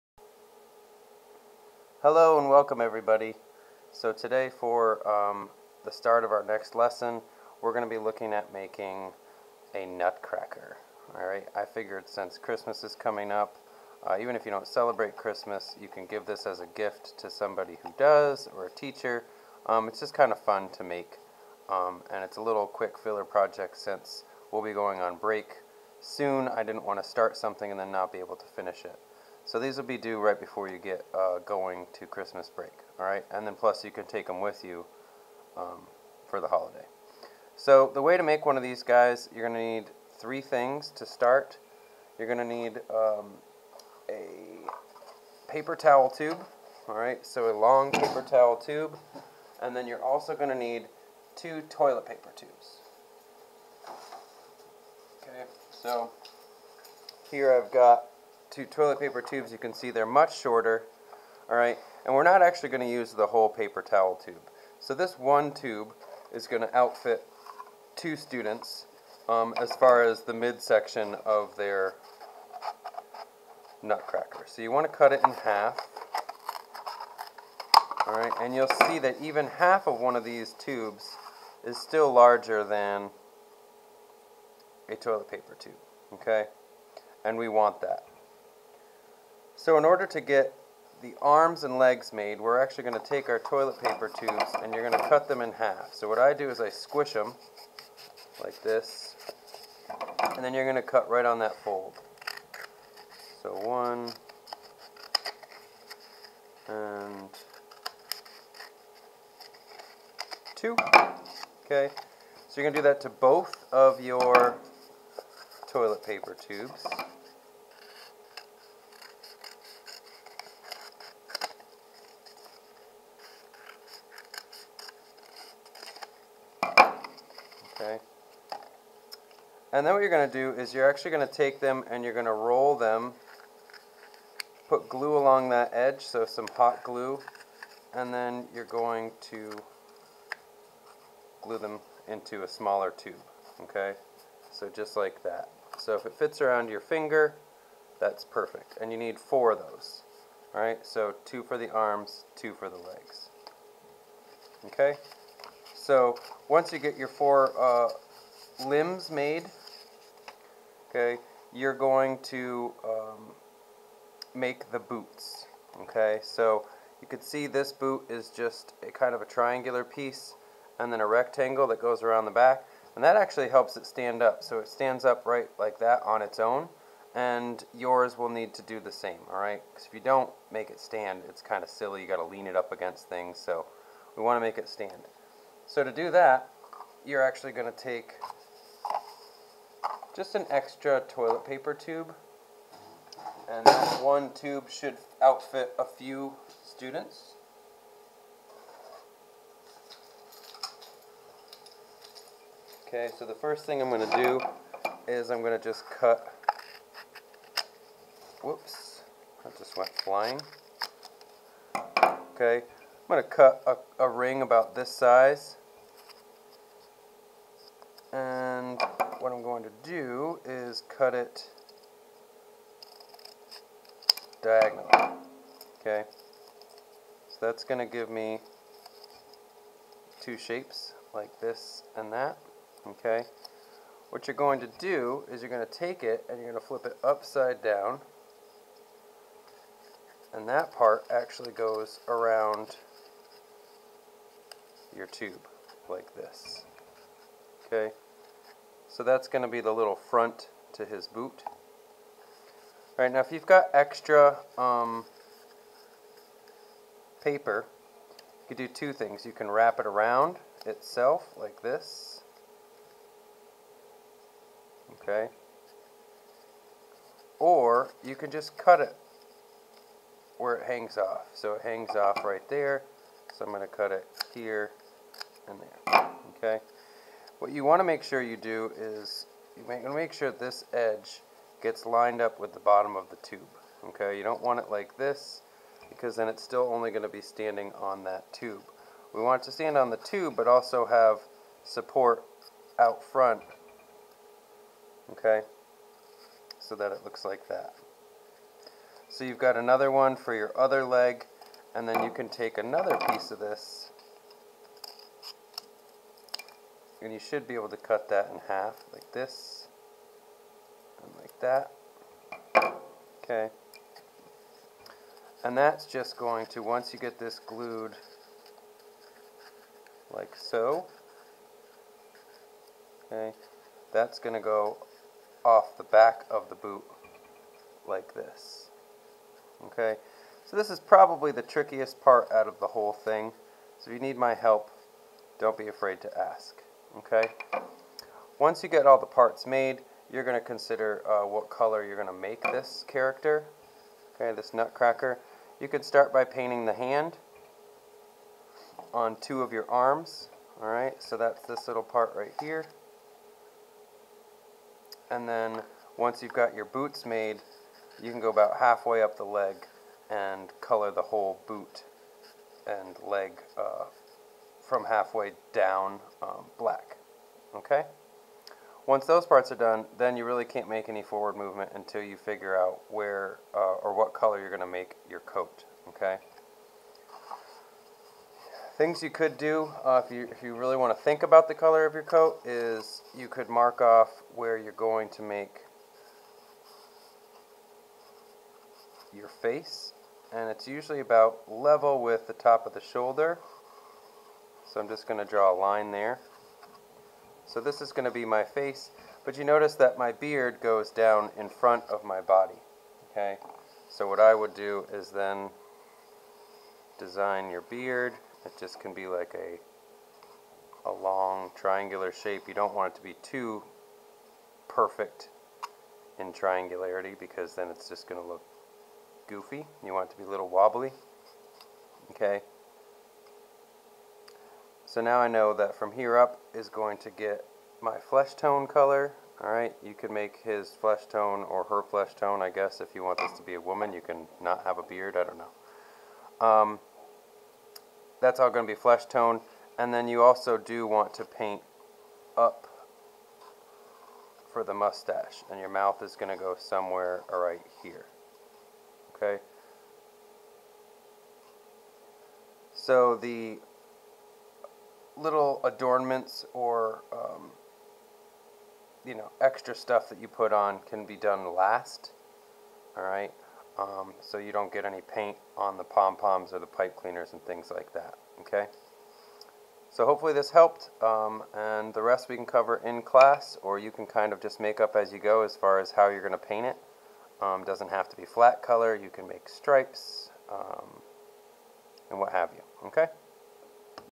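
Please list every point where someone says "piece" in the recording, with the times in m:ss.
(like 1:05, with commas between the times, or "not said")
2:49, 5:03.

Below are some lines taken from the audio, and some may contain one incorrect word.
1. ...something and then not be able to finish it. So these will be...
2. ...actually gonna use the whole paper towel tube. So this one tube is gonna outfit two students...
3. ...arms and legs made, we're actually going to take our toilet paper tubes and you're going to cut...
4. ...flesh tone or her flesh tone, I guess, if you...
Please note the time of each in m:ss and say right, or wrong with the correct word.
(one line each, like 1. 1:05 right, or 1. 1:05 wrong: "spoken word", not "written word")
1. 0:27 right
2. 1:02 right
3. 1:31 right
4. 7:10 right.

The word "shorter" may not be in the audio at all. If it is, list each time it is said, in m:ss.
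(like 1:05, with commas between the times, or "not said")
1:00.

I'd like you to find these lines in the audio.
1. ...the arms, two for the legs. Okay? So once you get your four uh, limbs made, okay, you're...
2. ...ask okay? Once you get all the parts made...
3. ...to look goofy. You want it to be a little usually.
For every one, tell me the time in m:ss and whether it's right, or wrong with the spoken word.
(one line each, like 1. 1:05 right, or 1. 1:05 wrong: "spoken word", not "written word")
1. 2:31 right
2. 5:36 right
3. 6:58 wrong: "wobbly", not "usually".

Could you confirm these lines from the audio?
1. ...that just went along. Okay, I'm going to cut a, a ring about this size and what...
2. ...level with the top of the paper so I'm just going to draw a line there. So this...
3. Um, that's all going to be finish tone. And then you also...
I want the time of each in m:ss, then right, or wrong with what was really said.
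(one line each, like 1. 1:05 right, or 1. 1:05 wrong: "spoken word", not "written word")
1. 3:29 wrong: "flying", not "along"
2. 6:31 wrong: "shoulder", not "paper"
3. 7:16 wrong: "flesh", not "finish".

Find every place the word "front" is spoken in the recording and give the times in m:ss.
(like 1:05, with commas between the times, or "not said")
4:09, 4:53, 6:41.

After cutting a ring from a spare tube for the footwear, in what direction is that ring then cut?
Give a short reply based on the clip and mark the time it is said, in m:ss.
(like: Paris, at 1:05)
diagonally, at 3:44.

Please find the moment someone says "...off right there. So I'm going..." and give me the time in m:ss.
4:31.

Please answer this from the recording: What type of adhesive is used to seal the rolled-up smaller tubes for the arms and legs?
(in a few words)
hot glue.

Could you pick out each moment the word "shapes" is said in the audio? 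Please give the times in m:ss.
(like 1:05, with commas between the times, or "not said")
3:50, 6:52.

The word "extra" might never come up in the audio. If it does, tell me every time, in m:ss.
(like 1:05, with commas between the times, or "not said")
3:10, 4:13, 7:39.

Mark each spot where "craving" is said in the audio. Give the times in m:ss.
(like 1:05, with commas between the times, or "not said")
not said.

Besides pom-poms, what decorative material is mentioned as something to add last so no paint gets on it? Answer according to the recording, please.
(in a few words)
pipe cleaners.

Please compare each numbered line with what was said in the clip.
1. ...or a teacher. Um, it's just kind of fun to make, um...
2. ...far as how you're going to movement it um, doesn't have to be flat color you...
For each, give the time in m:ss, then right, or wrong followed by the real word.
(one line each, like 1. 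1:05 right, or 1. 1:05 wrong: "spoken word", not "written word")
1. 0:18 right
2. 7:55 wrong: "paint", not "movement".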